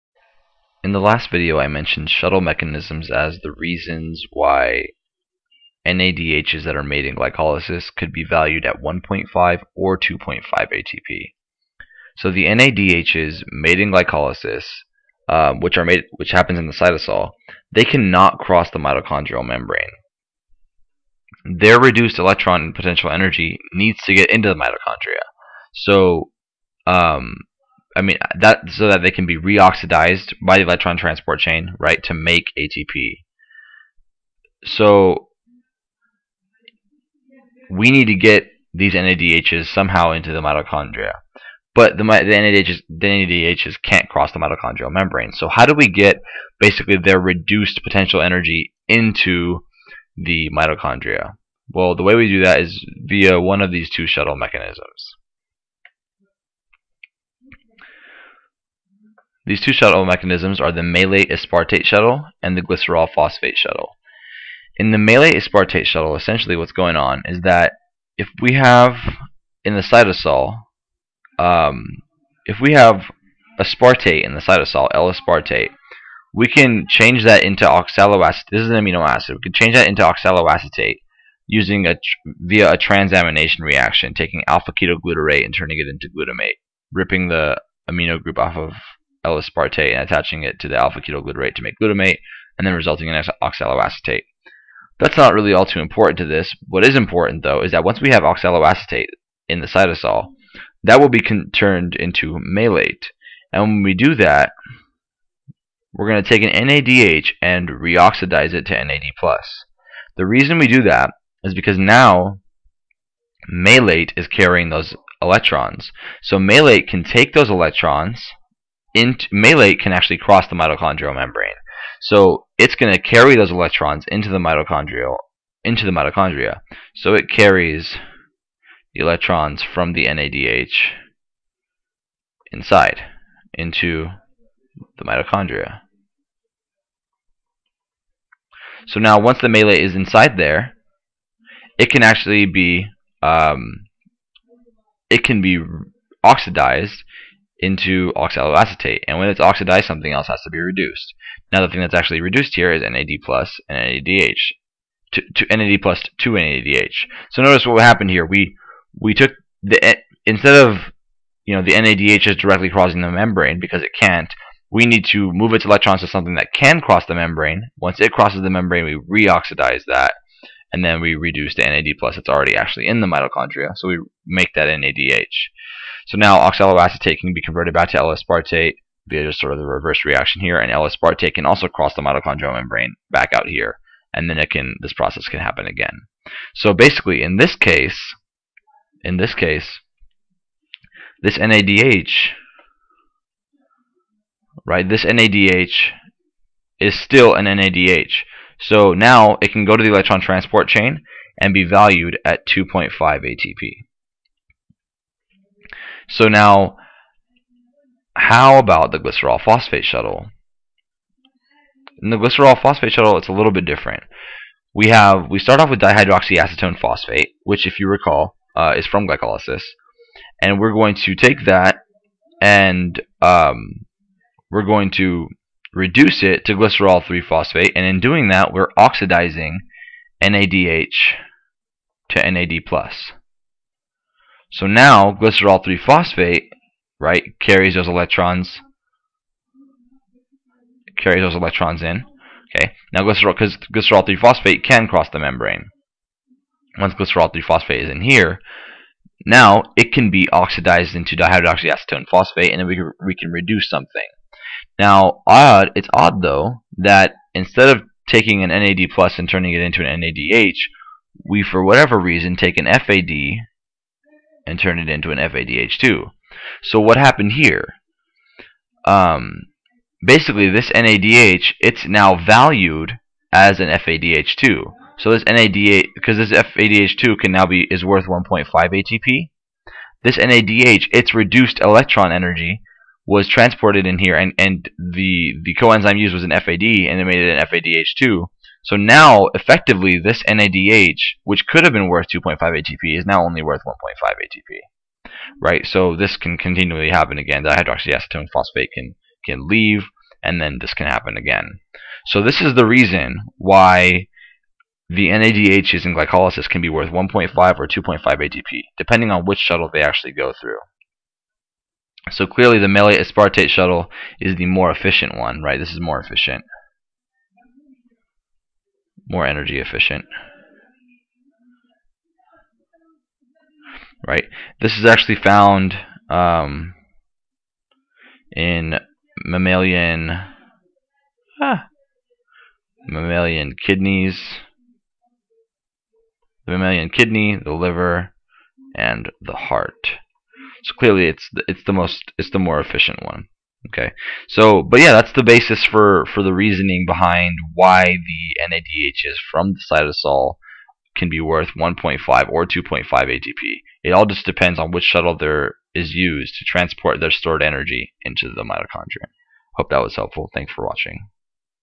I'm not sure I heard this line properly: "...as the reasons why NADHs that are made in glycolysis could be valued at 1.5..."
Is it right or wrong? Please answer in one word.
right.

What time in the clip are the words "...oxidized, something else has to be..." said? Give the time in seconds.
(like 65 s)
149 s.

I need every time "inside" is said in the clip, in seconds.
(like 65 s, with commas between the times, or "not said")
132 s, 139 s.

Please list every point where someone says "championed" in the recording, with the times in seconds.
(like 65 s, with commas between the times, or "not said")
not said.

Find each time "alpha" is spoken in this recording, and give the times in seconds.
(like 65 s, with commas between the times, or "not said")
84 s, 90 s.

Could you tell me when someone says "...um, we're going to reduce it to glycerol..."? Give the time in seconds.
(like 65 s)
223 s.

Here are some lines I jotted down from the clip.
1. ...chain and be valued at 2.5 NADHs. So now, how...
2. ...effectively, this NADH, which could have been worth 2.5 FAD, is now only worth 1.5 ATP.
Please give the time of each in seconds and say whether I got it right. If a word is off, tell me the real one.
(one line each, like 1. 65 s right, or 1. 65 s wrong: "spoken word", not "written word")
1. 200 s wrong: "ATP", not "NADHs"
2. 289 s wrong: "ATP", not "FAD".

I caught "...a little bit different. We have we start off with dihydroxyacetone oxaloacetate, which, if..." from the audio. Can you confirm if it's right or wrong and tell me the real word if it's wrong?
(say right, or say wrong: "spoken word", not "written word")
wrong: "phosphate", not "oxaloacetate".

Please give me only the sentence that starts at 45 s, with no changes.
So how do we get basically their reduced potential energy into the mitochondria?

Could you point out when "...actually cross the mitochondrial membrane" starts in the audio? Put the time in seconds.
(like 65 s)
119 s.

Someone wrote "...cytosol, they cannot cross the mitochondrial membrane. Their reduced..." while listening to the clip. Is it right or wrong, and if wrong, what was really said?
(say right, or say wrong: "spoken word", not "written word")
right.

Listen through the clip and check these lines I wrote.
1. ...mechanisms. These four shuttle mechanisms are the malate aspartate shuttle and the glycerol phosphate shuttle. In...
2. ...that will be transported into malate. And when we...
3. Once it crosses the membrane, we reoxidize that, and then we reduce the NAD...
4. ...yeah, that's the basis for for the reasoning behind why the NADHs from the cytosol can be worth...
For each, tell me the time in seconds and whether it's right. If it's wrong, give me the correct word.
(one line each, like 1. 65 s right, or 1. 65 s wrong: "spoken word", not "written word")
1. 54 s wrong: "two", not "four"
2. 100 s wrong: "turned", not "transported"
3. 167 s right
4. 344 s right.